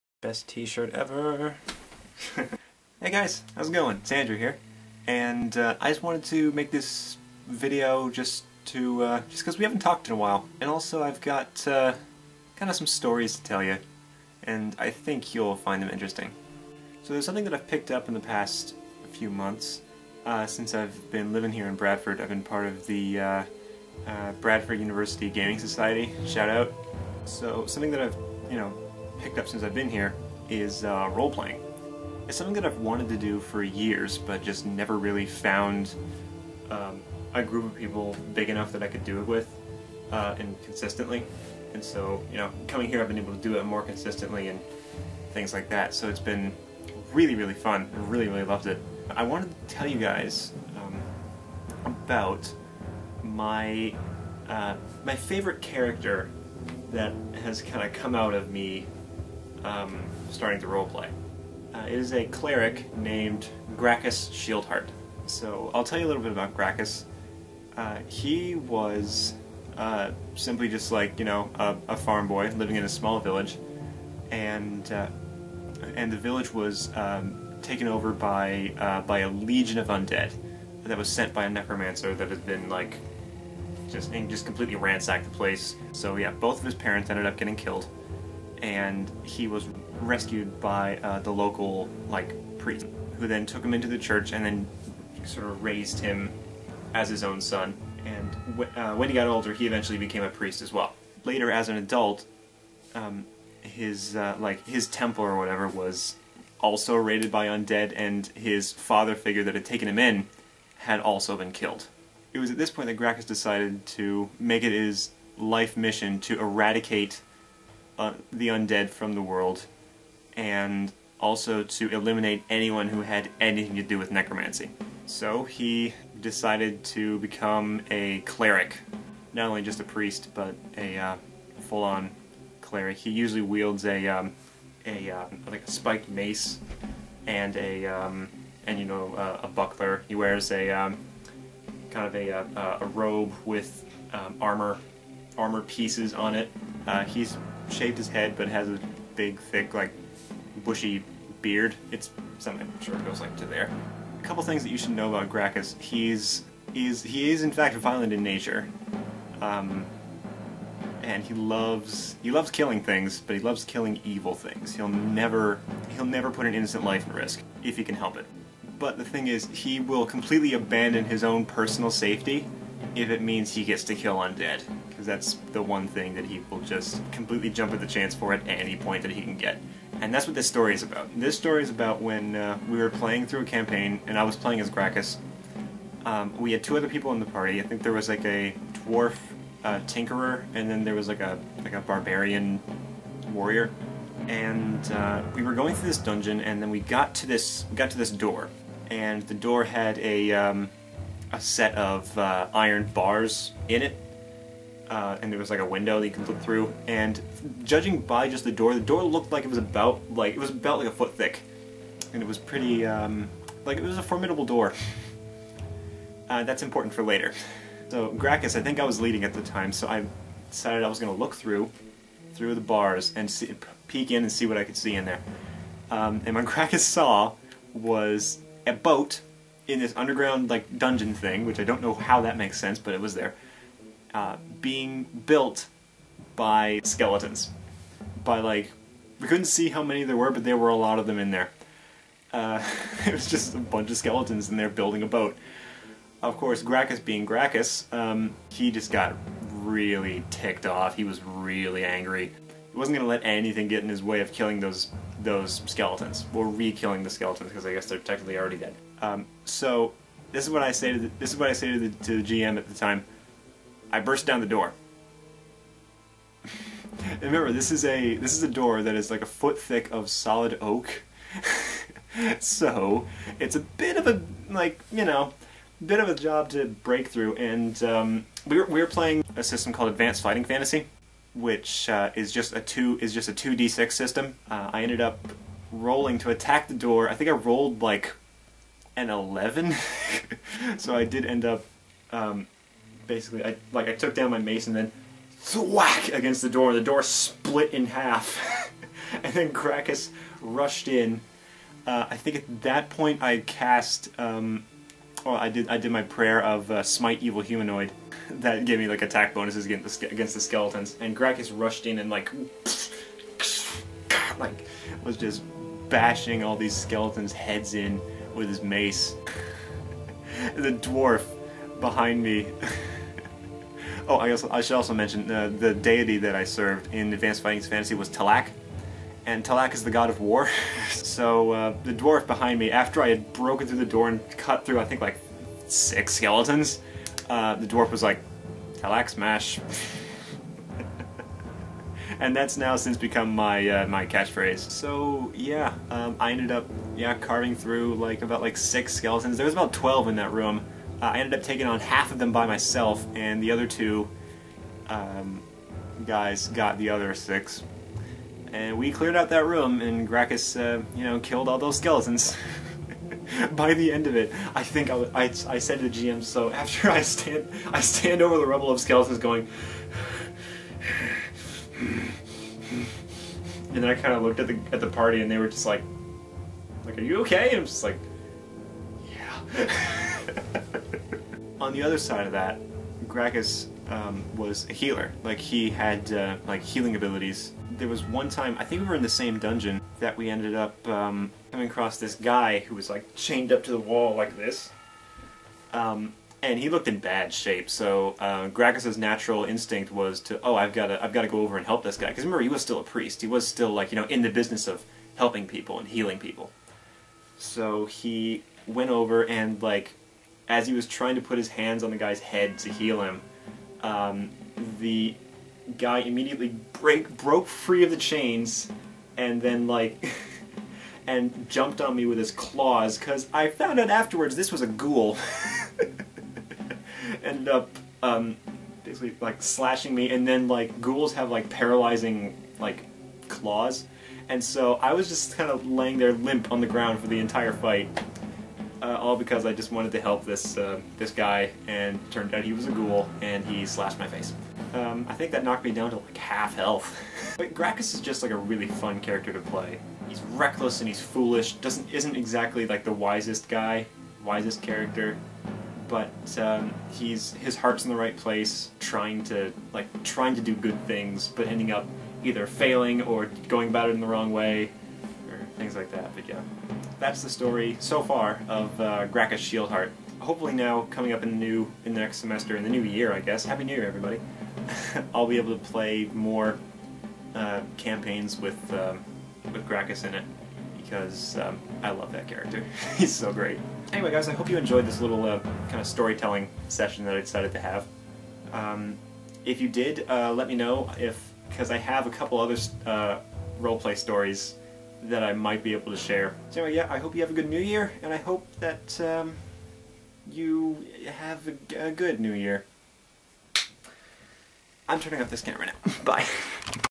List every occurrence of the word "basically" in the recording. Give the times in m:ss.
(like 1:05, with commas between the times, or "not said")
4:53, 7:08.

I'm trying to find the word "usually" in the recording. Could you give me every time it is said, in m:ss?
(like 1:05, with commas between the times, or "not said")
2:13.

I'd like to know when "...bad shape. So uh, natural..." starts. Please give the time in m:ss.
6:36.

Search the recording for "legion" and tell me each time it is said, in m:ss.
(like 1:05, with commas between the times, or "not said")
1:19.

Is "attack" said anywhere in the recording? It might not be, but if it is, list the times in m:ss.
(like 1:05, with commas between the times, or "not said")
4:46, 5:09.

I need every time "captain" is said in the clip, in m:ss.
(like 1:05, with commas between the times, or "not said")
not said.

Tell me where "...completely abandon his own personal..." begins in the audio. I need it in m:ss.
2:50.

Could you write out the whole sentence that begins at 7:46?
But yeah, that's the story so far of uh, Grakkas Shieldheart.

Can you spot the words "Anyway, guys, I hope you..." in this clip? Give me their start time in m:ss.
8:03.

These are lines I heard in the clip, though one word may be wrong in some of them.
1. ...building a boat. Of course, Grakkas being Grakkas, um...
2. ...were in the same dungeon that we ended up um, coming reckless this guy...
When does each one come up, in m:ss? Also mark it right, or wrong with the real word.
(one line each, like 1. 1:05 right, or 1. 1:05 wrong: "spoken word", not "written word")
1. 4:04 right
2. 6:28 wrong: "across", not "reckless".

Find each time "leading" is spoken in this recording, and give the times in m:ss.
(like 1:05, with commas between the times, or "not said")
3:39.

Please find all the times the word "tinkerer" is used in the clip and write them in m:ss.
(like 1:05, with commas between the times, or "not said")
3:09.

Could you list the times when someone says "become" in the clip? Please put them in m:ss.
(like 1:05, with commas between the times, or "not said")
2:07, 5:42.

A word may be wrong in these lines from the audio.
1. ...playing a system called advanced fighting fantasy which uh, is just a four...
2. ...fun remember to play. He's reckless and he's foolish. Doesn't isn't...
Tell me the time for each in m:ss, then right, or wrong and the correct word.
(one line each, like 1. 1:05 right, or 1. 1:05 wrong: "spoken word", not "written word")
1. 4:38 wrong: "two", not "four"
2. 7:28 wrong: "character", not "remember".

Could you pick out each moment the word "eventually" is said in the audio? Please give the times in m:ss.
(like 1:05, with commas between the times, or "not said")
1:39.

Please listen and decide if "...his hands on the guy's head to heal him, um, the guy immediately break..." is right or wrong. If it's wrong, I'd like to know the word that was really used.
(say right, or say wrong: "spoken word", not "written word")
right.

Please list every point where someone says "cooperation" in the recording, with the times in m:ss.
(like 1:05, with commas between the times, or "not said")
not said.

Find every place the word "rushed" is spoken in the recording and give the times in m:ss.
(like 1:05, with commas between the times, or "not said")
5:00, 5:11.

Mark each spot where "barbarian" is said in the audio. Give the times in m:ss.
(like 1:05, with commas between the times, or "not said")
3:11.